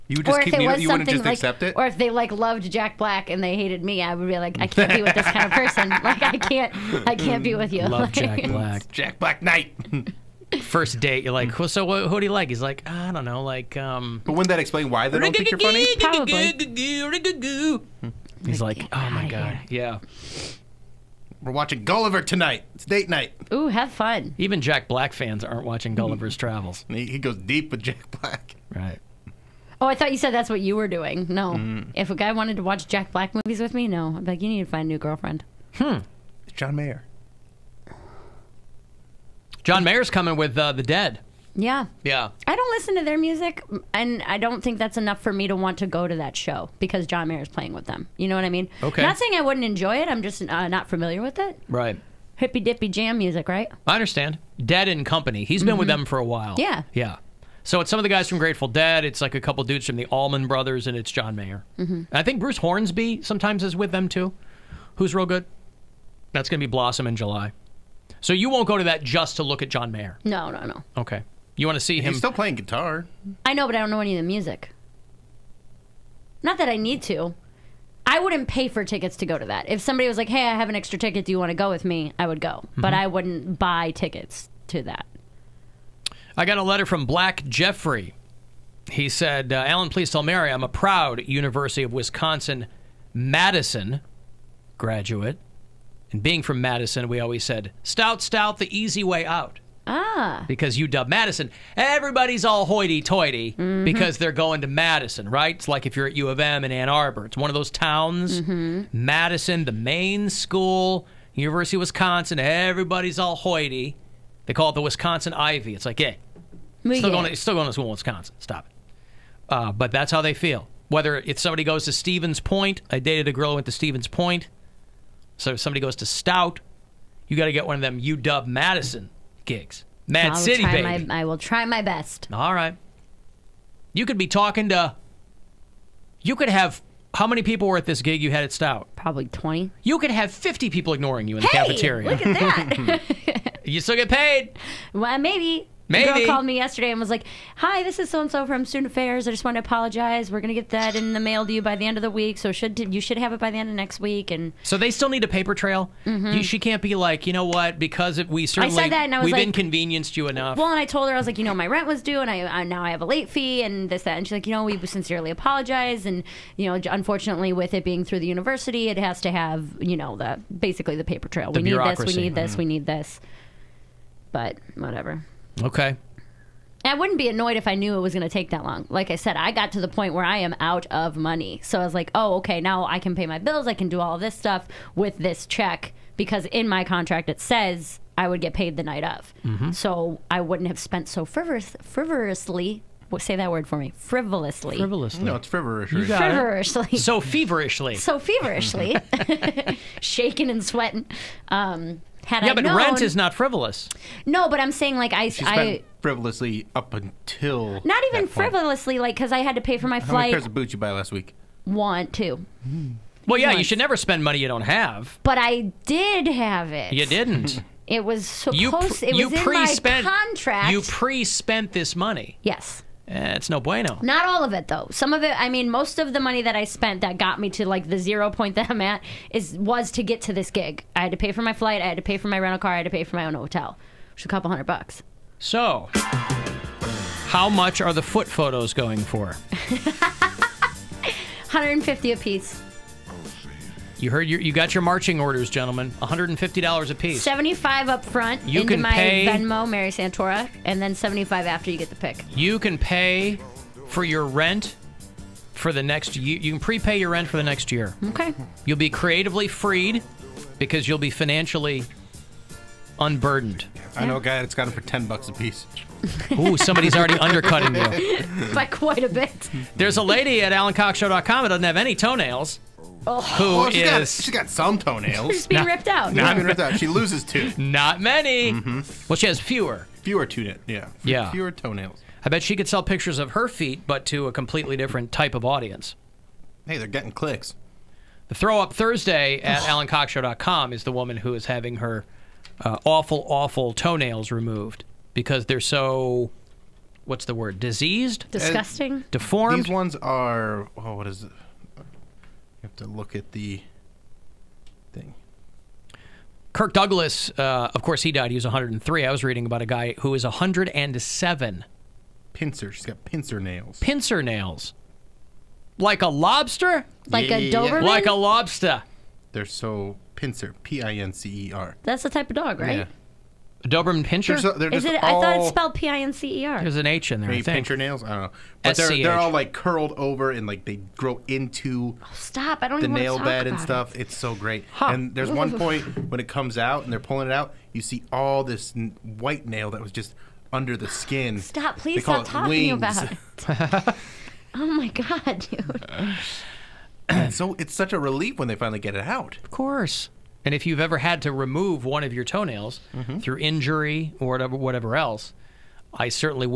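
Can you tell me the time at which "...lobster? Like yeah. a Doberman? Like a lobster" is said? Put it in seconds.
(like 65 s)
316 s.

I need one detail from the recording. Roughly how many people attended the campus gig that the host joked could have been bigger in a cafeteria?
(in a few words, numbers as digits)
20.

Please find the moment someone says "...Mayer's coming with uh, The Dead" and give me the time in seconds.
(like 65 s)
39 s.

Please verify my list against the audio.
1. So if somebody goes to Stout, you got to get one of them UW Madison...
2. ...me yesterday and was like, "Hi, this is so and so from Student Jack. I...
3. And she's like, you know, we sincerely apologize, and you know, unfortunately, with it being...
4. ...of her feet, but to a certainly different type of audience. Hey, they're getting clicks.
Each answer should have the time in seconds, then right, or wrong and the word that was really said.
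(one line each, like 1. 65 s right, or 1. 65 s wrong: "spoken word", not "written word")
1. 125 s right
2. 146 s wrong: "Affairs", not "Jack"
3. 164 s right
4. 283 s wrong: "completely", not "certainly".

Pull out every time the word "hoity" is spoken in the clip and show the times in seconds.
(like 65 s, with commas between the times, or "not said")
102 s, 113 s.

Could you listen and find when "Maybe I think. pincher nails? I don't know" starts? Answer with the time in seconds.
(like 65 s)
327 s.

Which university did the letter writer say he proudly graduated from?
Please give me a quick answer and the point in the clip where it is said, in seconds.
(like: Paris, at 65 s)
University of Wisconsin Madison, at 91 s.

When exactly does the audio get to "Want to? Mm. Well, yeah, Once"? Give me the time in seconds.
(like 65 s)
211 s.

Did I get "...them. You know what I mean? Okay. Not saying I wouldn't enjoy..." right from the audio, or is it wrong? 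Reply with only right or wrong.
right.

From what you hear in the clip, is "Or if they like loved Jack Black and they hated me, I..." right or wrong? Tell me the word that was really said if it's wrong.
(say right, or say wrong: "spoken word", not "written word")
right.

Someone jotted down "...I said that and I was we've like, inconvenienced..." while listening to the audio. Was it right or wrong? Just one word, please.
right.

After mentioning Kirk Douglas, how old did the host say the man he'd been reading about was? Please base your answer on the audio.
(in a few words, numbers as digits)
107.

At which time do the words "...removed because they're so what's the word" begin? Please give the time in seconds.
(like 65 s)
294 s.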